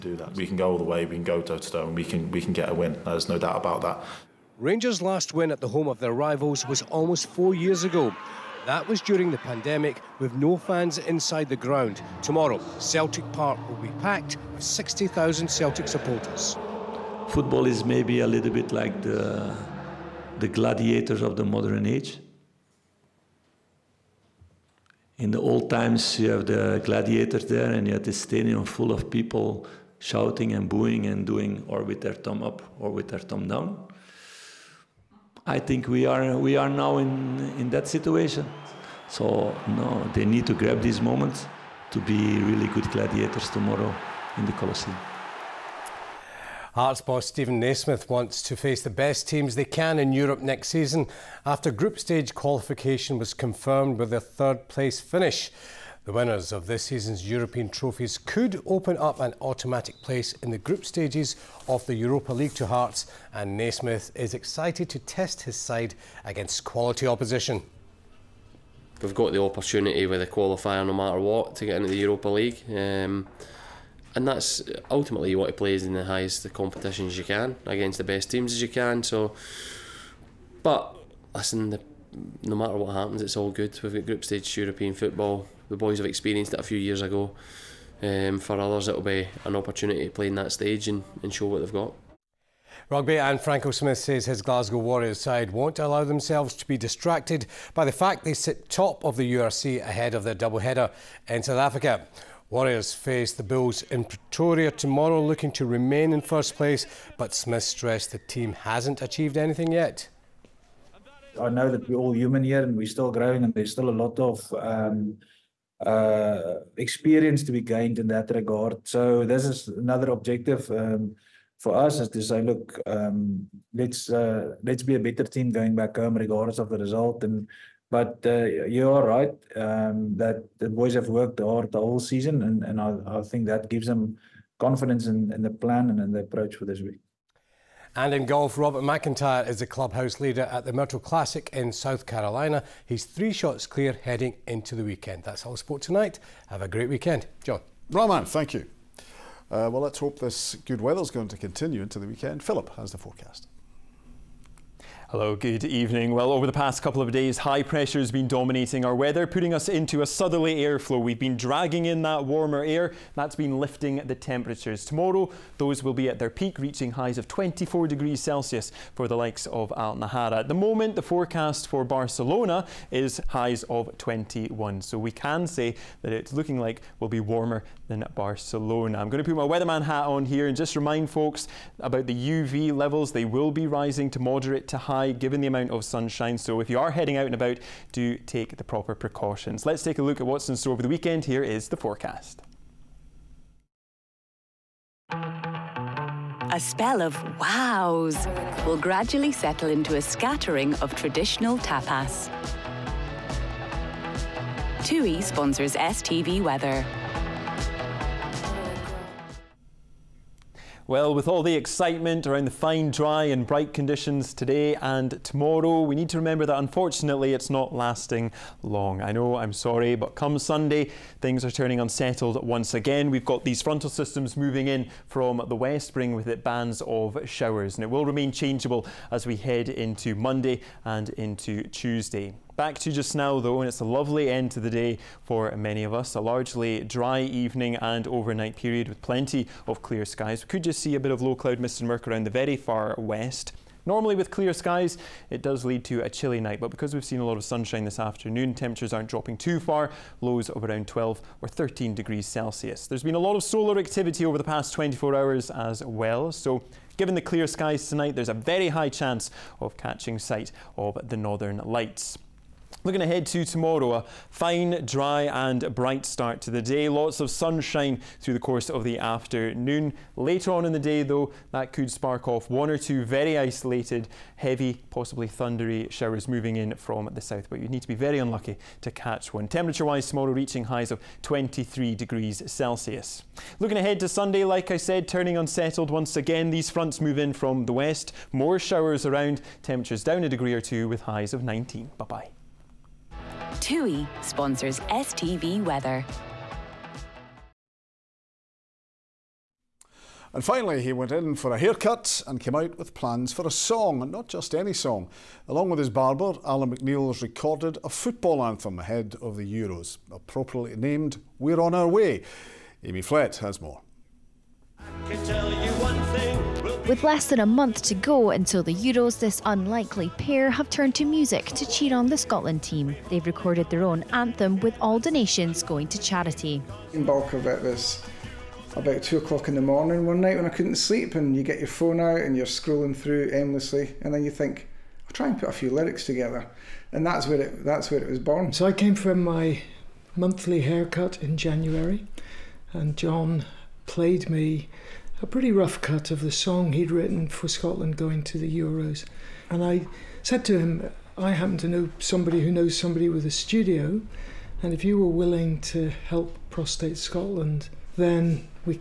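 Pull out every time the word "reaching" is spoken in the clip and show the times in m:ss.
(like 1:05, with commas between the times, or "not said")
2:46, 4:40.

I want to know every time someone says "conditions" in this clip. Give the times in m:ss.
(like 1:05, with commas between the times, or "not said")
3:33.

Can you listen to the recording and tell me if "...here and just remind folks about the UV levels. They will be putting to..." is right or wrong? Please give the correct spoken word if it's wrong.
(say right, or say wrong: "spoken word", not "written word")
wrong: "rising", not "putting".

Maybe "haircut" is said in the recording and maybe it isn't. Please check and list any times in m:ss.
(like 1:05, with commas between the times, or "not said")
5:01, 5:40.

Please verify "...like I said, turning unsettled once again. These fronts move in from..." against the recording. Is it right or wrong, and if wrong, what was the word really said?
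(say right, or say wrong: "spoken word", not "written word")
right.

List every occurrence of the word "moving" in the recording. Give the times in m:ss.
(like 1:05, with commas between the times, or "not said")
3:44, 4:36.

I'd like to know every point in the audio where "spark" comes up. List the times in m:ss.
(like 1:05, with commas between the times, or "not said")
4:31.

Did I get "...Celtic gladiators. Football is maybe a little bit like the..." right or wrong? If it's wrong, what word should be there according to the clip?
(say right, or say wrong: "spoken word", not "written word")
wrong: "supporters", not "gladiators".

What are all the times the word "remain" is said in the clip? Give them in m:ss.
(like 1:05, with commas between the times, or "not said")
1:45, 3:48.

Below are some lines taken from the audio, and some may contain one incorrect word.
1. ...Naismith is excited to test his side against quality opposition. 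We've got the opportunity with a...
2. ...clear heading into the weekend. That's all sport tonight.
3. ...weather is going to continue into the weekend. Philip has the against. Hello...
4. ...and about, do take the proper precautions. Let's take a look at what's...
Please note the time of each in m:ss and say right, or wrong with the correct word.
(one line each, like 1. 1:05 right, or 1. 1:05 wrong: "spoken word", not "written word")
1. 1:03 right
2. 2:23 right
3. 2:30 wrong: "forecast", not "against"
4. 3:07 right.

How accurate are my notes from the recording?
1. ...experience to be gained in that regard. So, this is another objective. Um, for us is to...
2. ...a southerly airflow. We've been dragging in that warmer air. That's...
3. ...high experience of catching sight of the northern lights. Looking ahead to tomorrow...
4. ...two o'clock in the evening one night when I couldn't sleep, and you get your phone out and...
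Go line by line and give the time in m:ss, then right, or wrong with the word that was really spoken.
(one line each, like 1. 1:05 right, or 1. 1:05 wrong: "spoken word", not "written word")
1. 1:56 right
2. 2:40 right
3. 4:18 wrong: "chance", not "experience"
4. 5:29 wrong: "morning", not "evening".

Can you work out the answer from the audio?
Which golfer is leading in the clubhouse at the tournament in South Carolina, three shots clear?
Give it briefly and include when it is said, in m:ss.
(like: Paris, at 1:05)
Robert McIntyre, at 2:18.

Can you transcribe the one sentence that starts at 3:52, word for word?
Back to just now though, and it's a lovely end to the day for many of us.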